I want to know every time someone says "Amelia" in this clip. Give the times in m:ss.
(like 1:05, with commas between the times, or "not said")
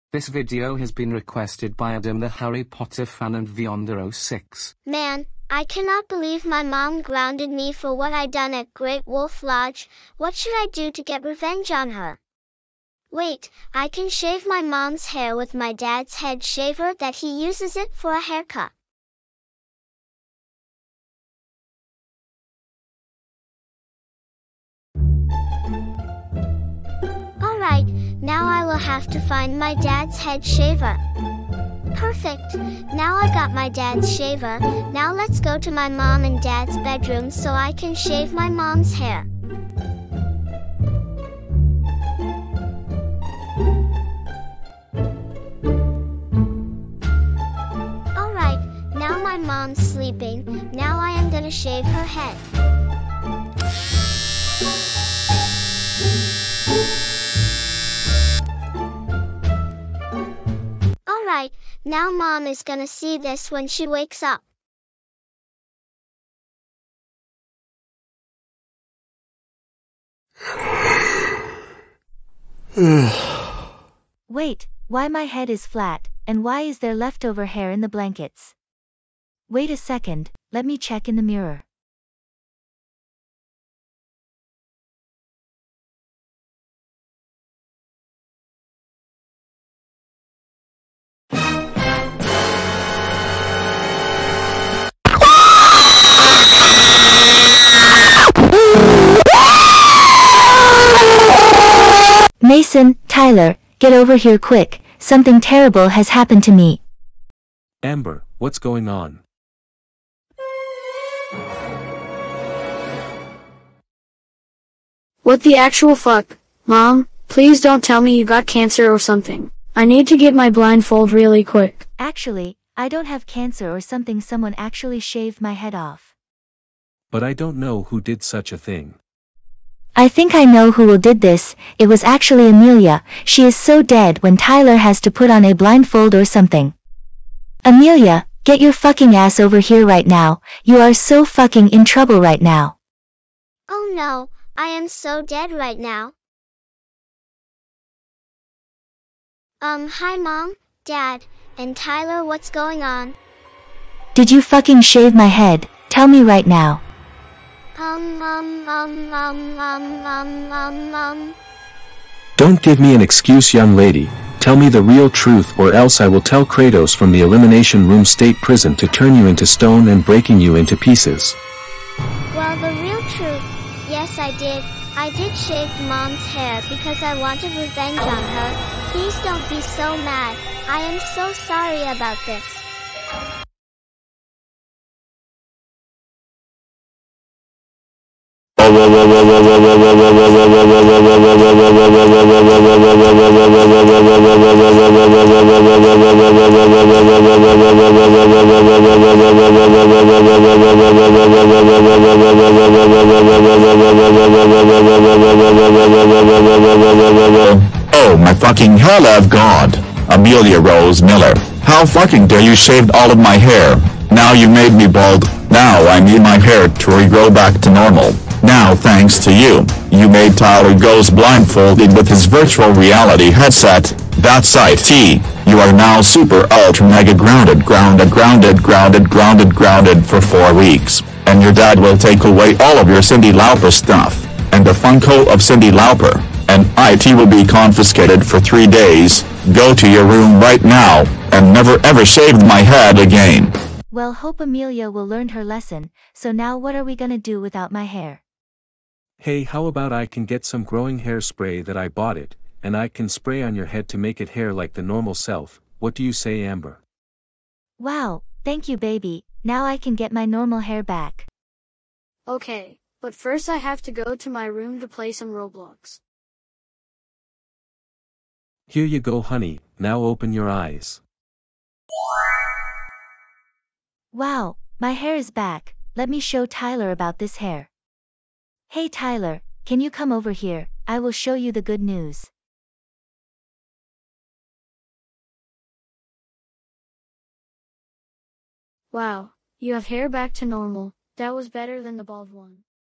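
2:12, 2:17, 3:30, 4:04.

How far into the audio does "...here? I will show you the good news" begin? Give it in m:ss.
4:40.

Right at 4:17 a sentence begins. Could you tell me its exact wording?
Wow, thank you baby, now I can get my normal hair back.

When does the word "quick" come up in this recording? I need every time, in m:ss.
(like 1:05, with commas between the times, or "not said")
1:44, 2:01.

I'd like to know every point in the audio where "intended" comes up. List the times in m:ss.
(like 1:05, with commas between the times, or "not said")
not said.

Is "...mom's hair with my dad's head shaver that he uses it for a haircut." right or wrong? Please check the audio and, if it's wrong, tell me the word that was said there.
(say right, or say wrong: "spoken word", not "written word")
right.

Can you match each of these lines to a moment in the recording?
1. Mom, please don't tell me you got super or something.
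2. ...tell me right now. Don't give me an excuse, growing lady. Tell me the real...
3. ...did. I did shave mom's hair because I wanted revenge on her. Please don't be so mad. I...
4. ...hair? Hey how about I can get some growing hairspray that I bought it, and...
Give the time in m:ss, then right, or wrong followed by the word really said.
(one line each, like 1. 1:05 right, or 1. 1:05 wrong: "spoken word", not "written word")
1. 1:56 wrong: "cancer", not "super"
2. 2:35 wrong: "young", not "growing"
3. 2:54 right
4. 4:07 right.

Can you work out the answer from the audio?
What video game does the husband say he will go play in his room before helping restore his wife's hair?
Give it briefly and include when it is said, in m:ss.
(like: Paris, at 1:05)
Roblox, at 4:25.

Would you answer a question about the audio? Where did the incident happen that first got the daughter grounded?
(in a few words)
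Great Wolf Lodge.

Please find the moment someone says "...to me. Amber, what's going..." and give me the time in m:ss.
1:46.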